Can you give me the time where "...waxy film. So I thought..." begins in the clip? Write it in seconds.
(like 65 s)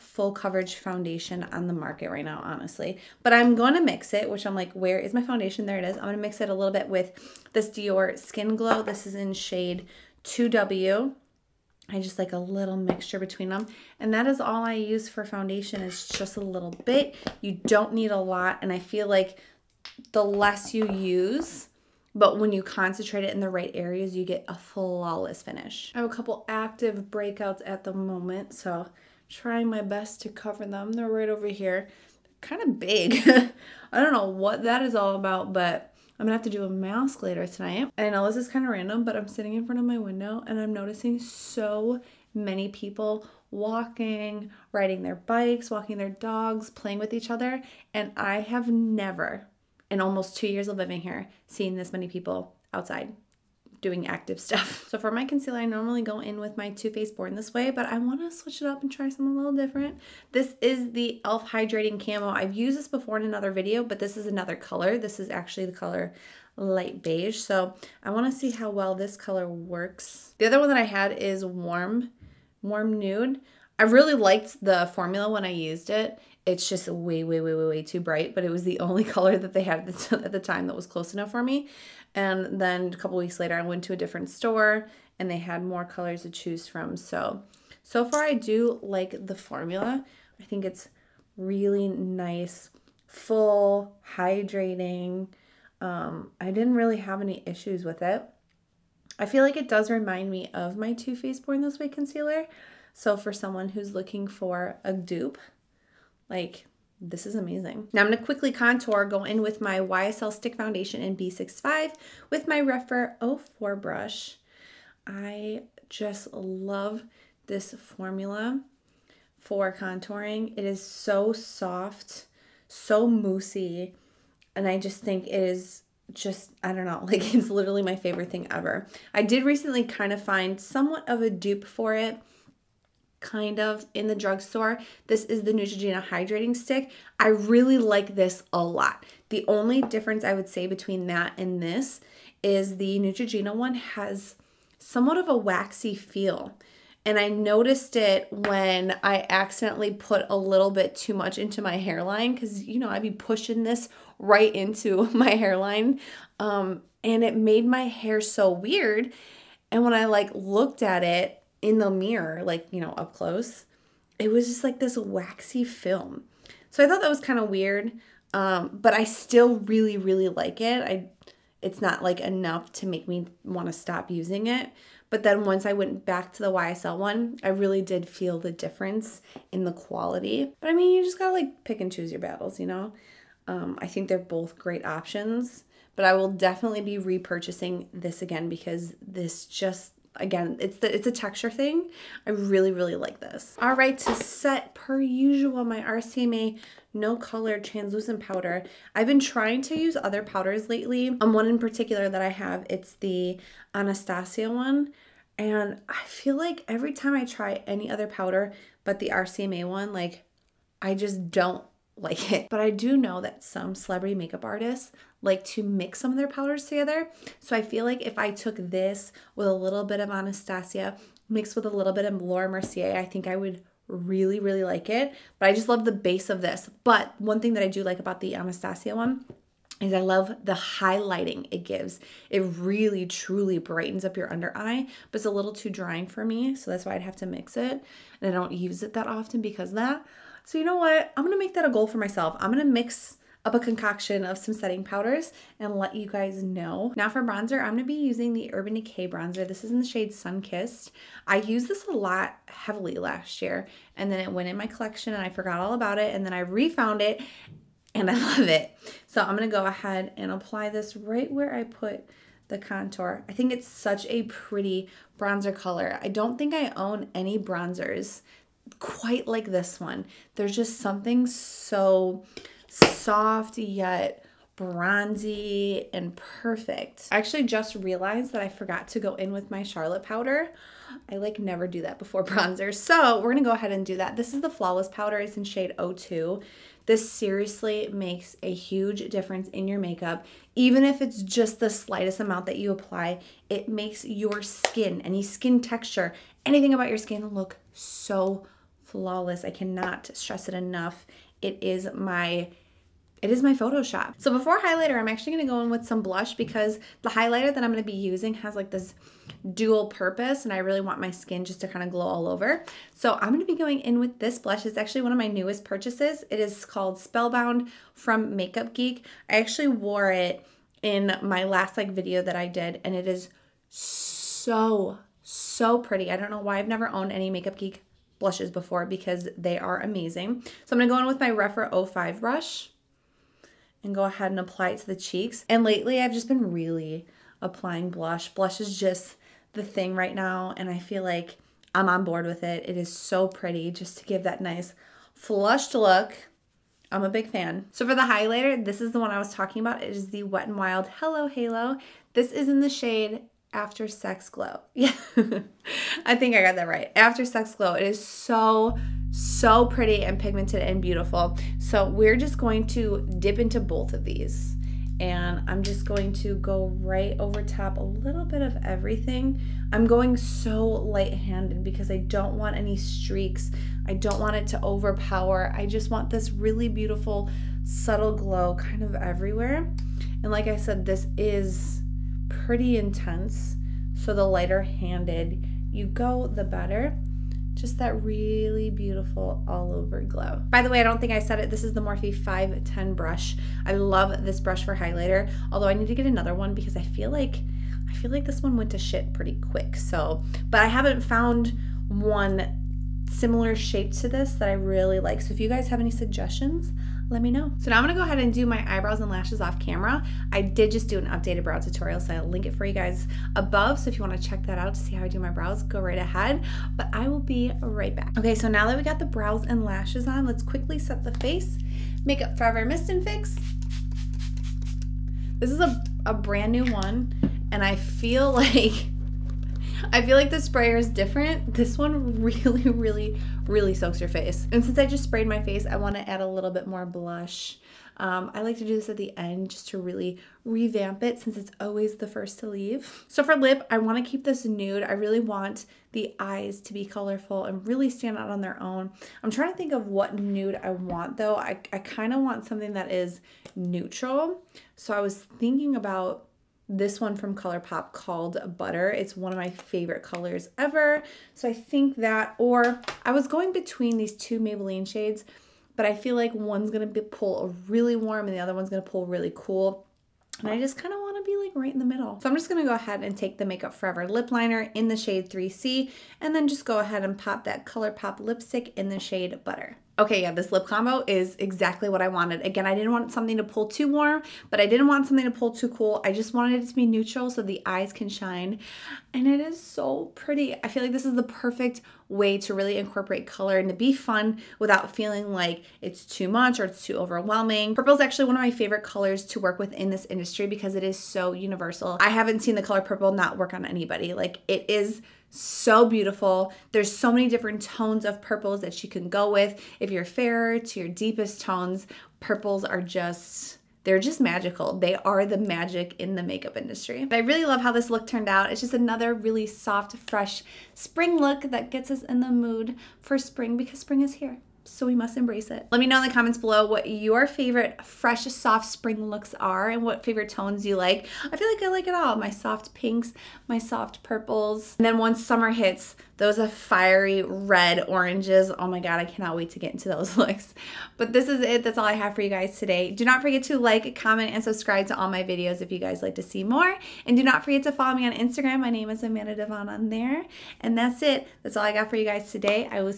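164 s.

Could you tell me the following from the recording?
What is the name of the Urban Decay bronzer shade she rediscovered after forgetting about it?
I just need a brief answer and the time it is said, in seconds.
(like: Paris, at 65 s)
Sun Kissed, at 250 s.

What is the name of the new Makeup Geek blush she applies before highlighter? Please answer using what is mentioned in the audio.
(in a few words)
Spellbound.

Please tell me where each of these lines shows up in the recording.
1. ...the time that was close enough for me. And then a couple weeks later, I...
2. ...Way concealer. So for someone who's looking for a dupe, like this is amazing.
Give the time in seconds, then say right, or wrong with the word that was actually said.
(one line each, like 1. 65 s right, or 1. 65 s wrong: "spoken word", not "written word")
1. 80 s right
2. 101 s right.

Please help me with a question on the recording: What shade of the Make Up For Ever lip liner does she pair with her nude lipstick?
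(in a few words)
3C.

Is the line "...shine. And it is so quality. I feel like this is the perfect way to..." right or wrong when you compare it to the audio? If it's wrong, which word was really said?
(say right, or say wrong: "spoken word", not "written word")
wrong: "pretty", not "quality".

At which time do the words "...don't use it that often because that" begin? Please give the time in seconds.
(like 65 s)
238 s.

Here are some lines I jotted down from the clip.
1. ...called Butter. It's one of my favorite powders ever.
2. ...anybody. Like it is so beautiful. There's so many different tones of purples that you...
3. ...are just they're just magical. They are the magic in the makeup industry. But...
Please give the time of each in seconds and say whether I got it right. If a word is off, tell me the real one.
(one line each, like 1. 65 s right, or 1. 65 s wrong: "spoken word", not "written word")
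1. 457 s wrong: "colors", not "powders"
2. 503 s right
3. 512 s right.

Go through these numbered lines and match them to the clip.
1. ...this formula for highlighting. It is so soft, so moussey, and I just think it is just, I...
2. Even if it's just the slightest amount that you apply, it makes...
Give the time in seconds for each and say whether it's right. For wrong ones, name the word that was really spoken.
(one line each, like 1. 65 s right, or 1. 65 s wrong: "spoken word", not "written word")
1. 117 s wrong: "contouring", not "highlighting"
2. 290 s right.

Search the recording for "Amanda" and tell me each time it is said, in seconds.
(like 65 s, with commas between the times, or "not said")
549 s.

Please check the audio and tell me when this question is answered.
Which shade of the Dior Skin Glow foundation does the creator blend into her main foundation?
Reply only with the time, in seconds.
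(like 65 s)
10 s.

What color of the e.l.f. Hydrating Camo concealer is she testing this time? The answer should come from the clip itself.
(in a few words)
light beige.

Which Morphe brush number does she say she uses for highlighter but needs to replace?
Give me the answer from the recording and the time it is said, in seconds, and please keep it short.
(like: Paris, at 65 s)
510, at 392 s.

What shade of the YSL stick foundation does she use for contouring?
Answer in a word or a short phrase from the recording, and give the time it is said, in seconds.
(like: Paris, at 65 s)
B65, at 111 s.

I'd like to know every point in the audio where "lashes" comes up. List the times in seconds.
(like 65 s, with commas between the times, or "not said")
409 s, 419 s.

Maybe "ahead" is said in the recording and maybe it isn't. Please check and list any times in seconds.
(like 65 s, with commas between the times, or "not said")
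259 s, 283 s, 334 s, 408 s, 415 s, 472 s, 476 s.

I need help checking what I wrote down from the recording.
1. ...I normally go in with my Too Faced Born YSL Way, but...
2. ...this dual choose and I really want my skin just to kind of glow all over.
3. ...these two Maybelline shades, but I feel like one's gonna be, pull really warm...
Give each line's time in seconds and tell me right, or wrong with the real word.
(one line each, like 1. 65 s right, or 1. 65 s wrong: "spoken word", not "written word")
1. 55 s wrong: "This", not "YSL"
2. 308 s wrong: "purpose", not "choose"
3. 463 s right.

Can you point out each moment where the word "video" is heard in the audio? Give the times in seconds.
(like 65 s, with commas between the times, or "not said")
63 s, 321 s, 545 s.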